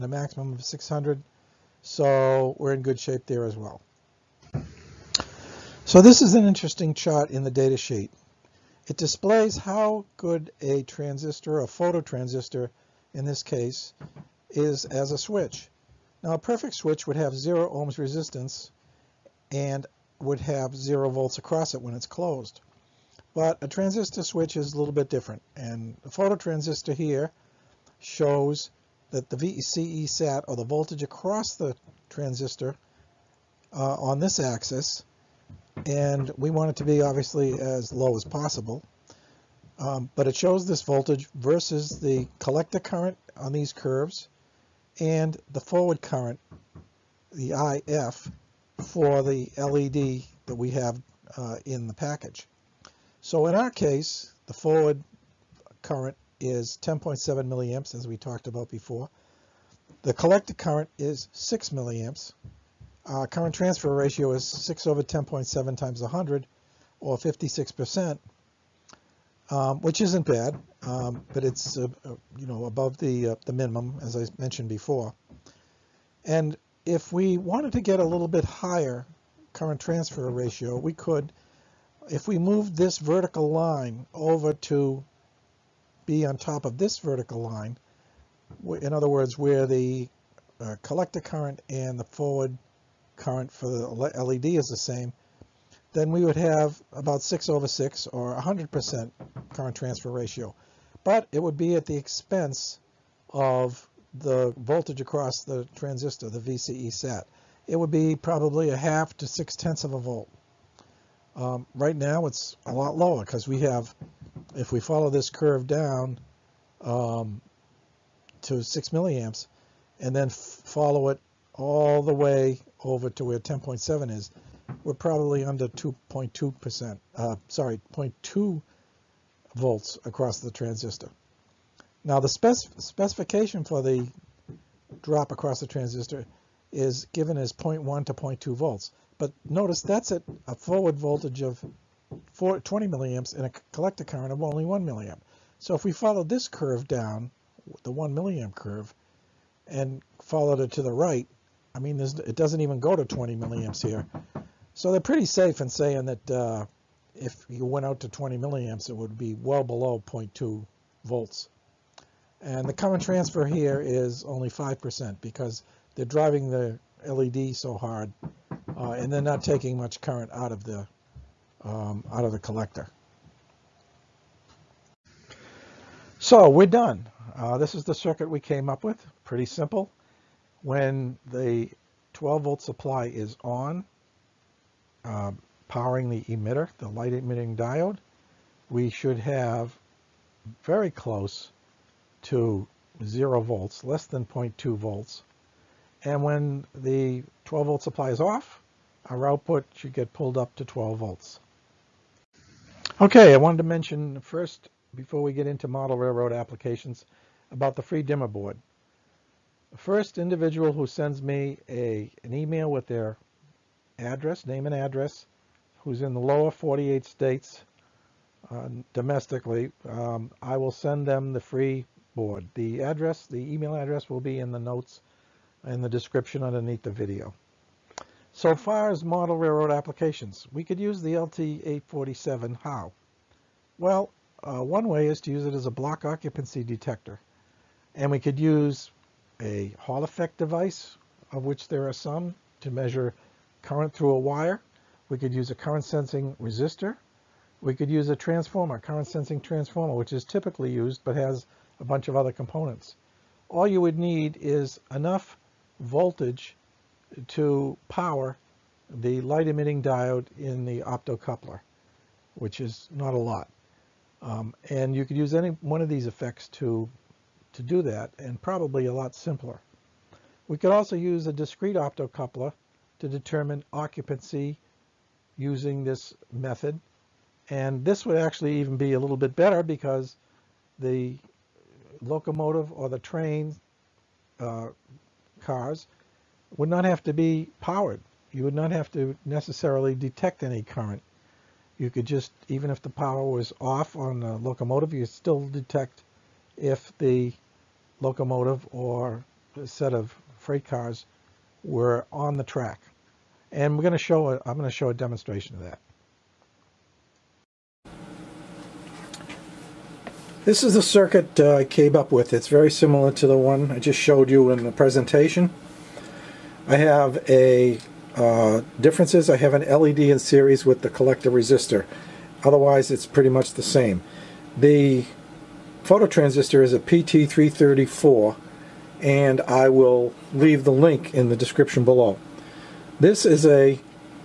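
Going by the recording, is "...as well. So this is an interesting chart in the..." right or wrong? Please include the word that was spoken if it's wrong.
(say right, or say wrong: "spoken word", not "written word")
right.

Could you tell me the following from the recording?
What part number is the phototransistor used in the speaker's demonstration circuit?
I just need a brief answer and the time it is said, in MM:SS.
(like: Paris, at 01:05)
PT334, at 05:26.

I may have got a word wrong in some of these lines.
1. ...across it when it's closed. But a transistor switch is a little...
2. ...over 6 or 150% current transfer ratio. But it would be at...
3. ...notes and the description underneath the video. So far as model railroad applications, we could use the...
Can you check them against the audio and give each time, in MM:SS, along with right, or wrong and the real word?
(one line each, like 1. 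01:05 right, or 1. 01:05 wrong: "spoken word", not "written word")
1. 00:21 right
2. 01:37 wrong: "100", not "150"
3. 03:44 right.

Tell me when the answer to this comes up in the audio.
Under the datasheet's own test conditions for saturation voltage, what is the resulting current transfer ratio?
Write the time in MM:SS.
02:44.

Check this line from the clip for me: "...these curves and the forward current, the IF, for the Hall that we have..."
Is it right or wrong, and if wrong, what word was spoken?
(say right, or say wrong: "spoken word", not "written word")
wrong: "LED", not "Hall".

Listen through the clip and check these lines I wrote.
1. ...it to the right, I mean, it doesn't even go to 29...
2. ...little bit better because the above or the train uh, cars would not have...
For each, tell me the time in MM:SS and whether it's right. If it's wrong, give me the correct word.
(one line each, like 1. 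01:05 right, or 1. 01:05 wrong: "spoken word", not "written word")
1. 02:30 wrong: "20", not "29"
2. 04:38 wrong: "locomotive", not "above".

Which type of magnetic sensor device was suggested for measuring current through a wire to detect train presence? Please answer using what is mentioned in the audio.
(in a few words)
Hall effect device.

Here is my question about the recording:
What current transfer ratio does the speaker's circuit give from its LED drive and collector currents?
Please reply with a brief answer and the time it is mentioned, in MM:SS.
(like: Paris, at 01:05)
56%, at 01:07.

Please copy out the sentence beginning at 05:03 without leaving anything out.
And we're going to show, a, I'm going to show a demonstration of that.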